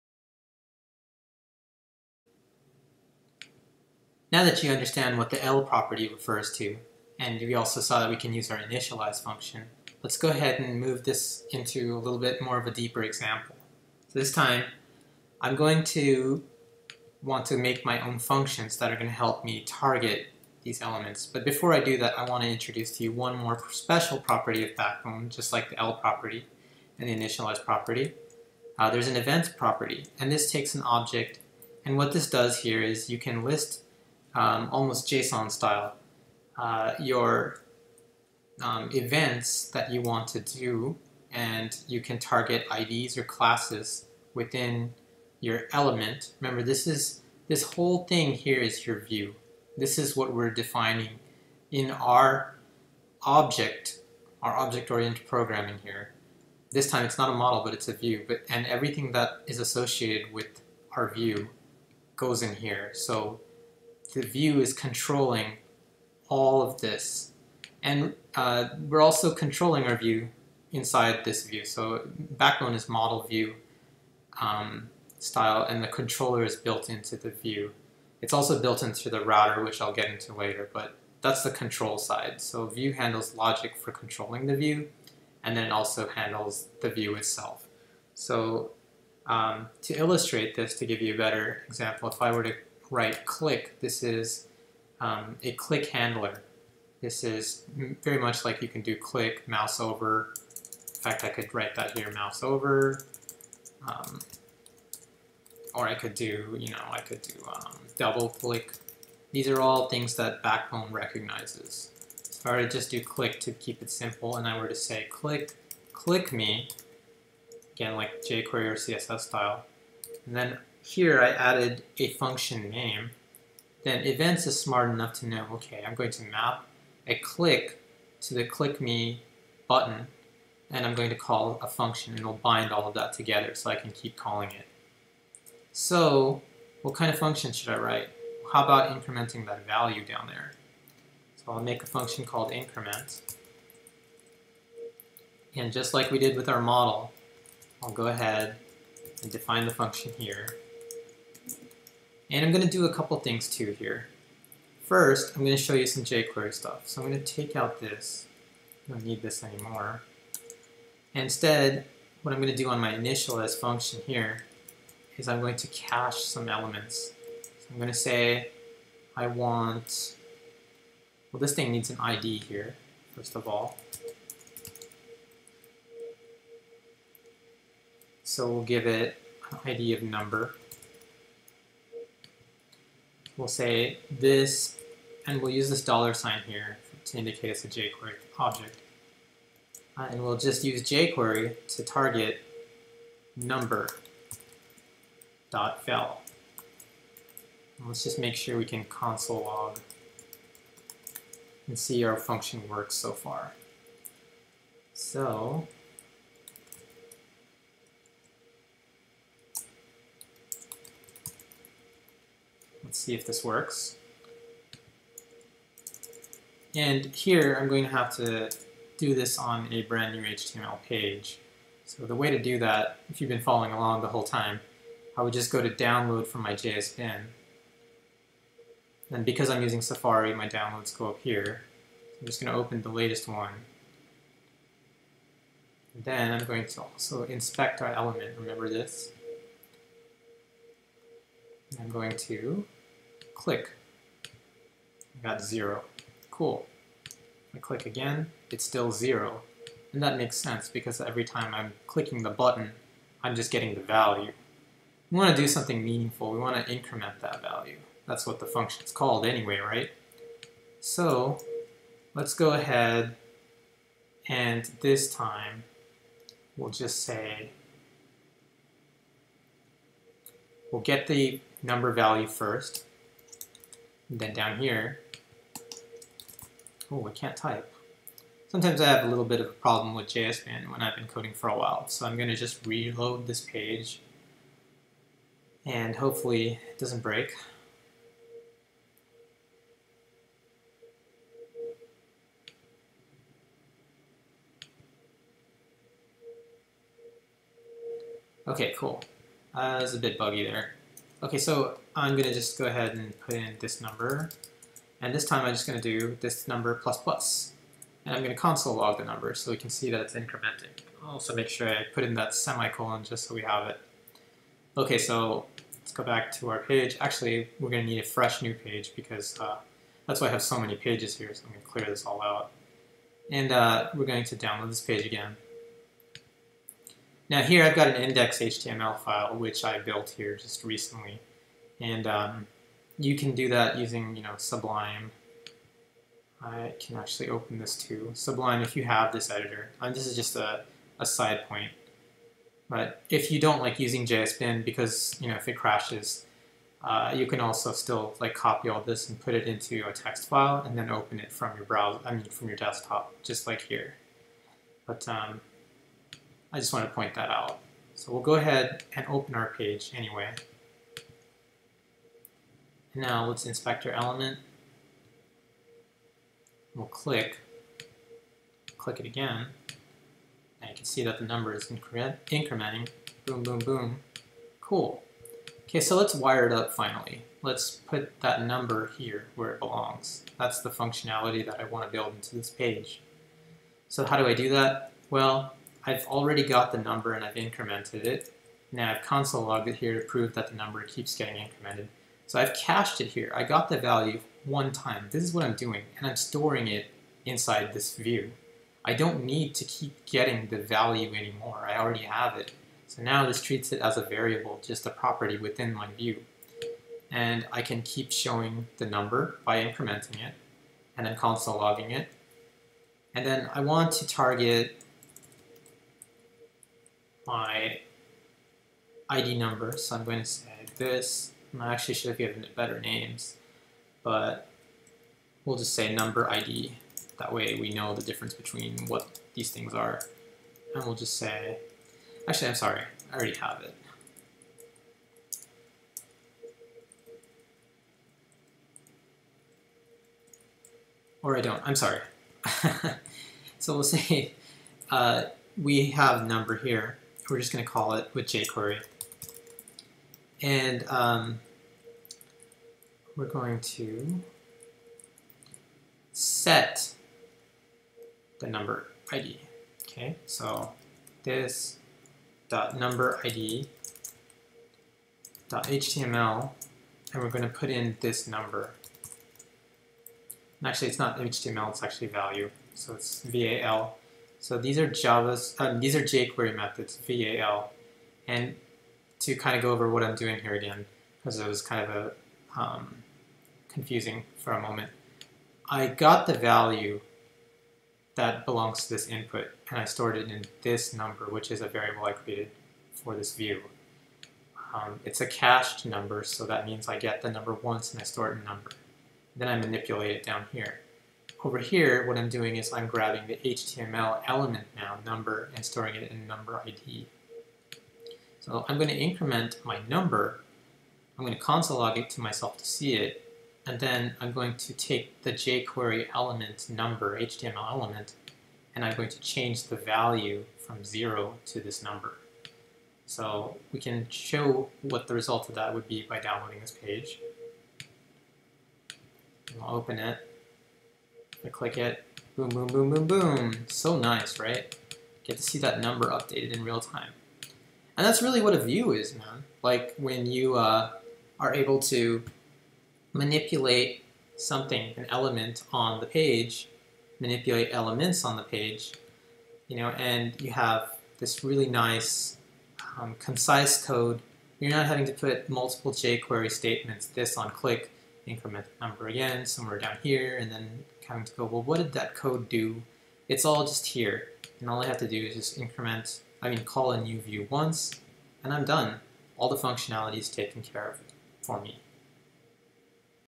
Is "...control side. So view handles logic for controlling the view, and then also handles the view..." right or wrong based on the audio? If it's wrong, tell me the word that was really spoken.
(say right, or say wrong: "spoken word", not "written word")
right.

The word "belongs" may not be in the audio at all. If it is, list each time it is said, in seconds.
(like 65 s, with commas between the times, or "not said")
379 s, 488 s.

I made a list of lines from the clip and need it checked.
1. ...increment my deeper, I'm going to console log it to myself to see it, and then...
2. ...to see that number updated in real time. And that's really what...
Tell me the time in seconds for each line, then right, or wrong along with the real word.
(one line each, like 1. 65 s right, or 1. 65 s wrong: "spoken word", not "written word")
1. 508 s wrong: "number", not "deeper"
2. 535 s right.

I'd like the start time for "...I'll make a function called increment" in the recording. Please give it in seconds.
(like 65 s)
141 s.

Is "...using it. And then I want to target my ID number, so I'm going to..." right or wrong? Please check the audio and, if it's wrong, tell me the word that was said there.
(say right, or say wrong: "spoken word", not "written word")
wrong: "logging", not "using".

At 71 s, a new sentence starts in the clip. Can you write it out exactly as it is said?
So backbone is model view um, style, and the controller is built into the view.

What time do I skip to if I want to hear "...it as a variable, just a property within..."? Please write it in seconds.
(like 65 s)
403 s.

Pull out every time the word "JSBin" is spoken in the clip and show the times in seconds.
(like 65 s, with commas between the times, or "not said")
280 s, 344 s.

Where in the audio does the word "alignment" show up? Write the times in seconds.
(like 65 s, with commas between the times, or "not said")
not said.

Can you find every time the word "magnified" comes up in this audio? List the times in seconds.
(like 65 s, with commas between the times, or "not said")
not said.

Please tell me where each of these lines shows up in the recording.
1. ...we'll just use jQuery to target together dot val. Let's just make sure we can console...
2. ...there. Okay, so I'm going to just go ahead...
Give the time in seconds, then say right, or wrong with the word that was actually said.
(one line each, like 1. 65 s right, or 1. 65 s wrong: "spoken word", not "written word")
1. 190 s wrong: "number", not "together"
2. 300 s right.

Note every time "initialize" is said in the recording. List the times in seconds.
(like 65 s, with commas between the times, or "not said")
8 s, 27 s, 162 s.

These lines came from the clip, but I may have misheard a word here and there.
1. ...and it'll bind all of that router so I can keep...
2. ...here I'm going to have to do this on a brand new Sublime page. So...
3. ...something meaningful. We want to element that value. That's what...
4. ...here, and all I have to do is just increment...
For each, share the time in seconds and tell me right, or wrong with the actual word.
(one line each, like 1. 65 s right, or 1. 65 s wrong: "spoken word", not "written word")
1. 132 s wrong: "together", not "router"
2. 217 s wrong: "HTML", not "Sublime"
3. 255 s wrong: "increment", not "element"
4. 563 s right.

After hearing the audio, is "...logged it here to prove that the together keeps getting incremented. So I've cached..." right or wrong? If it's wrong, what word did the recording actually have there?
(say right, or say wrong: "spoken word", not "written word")
wrong: "number", not "together".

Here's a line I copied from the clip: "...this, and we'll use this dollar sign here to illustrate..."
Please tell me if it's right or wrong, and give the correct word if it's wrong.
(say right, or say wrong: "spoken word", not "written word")
wrong: "indicate", not "illustrate".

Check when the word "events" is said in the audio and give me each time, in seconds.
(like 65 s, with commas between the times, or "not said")
29 s, 38 s, 124 s.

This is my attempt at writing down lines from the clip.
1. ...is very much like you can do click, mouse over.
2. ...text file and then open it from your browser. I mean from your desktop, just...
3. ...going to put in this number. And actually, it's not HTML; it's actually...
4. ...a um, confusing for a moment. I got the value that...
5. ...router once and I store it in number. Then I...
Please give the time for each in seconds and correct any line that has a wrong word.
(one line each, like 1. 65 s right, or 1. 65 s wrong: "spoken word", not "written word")
1. 97 s right
2. 349 s right
3. 467 s right
4. 481 s right
5. 497 s wrong: "number", not "router".